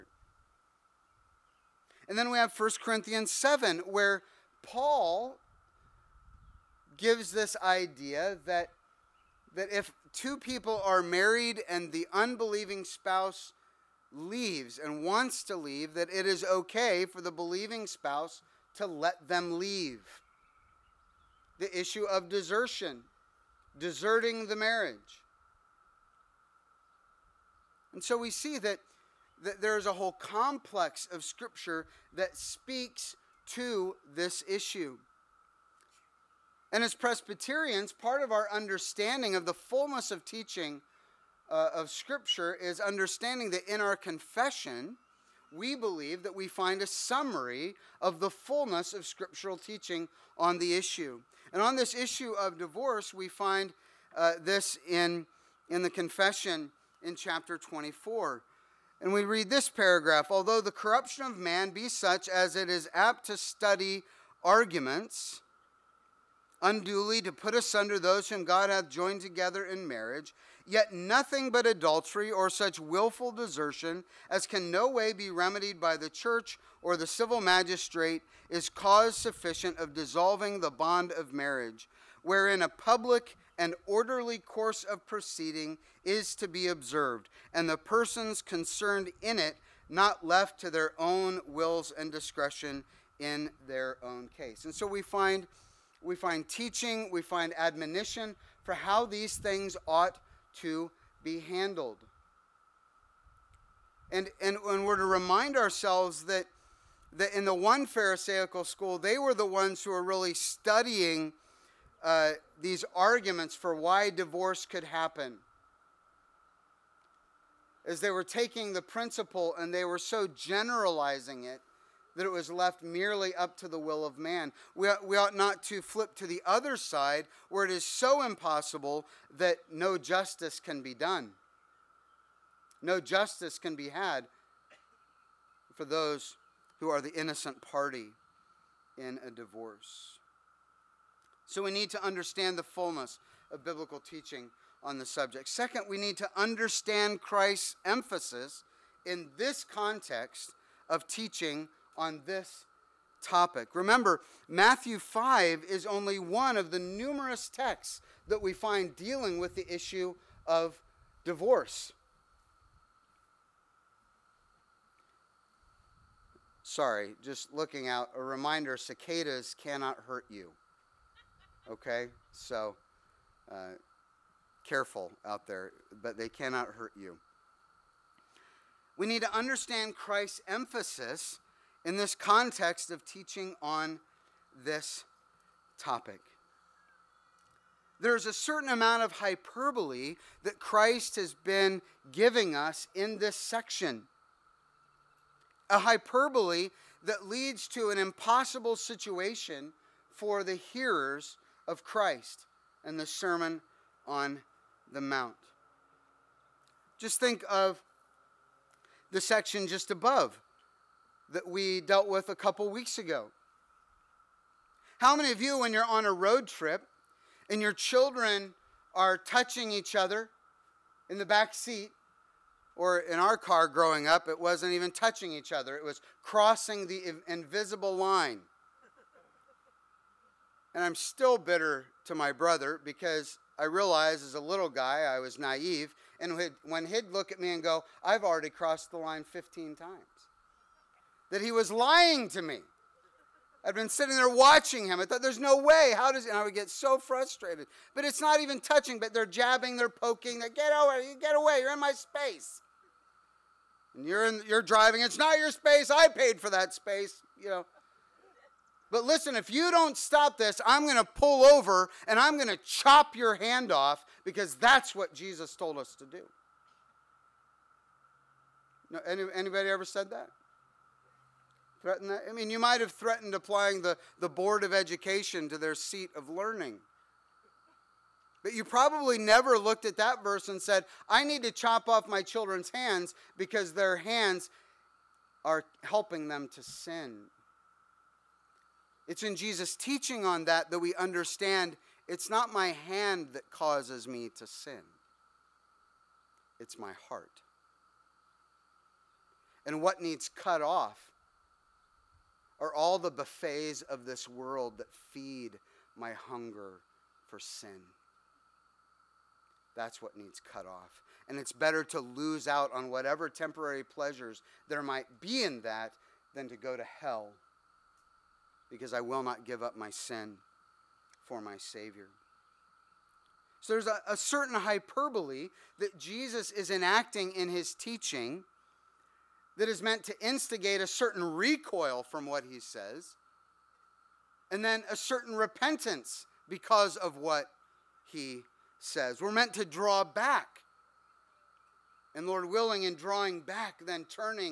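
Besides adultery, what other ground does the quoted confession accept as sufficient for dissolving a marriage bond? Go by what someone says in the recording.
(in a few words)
Wilful desertion.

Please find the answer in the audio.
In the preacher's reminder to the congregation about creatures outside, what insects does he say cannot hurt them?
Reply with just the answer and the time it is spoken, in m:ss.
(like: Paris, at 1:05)
Cicadas, at 2:48.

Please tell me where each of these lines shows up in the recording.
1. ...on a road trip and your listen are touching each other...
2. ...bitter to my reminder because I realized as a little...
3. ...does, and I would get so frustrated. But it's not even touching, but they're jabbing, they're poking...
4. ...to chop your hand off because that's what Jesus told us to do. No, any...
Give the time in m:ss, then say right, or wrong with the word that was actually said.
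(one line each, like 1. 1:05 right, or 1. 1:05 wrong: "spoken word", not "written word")
1. 3:35 wrong: "children", not "listen"
2. 3:51 wrong: "brother", not "reminder"
3. 4:06 right
4. 4:22 right.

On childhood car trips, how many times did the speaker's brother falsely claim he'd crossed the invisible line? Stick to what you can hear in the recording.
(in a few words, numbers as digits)
15.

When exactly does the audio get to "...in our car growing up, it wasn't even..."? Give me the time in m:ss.
3:43.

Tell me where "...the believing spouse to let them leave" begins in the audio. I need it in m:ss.
0:17.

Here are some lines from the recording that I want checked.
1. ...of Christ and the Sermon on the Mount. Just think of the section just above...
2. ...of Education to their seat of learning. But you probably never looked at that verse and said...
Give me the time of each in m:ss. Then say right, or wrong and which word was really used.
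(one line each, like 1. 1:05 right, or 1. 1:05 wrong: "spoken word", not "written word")
1. 3:21 right
2. 4:34 right.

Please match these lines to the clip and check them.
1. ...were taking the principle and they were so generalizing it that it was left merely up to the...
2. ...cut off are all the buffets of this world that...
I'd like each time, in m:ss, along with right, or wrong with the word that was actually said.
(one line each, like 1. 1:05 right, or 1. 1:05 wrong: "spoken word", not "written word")
1. 1:58 right
2. 5:00 right.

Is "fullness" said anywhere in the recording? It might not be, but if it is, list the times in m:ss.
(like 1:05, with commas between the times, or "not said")
0:39, 0:48, 2:22.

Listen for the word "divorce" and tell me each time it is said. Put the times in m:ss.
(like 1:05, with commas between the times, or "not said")
0:52, 1:54, 2:19, 2:41.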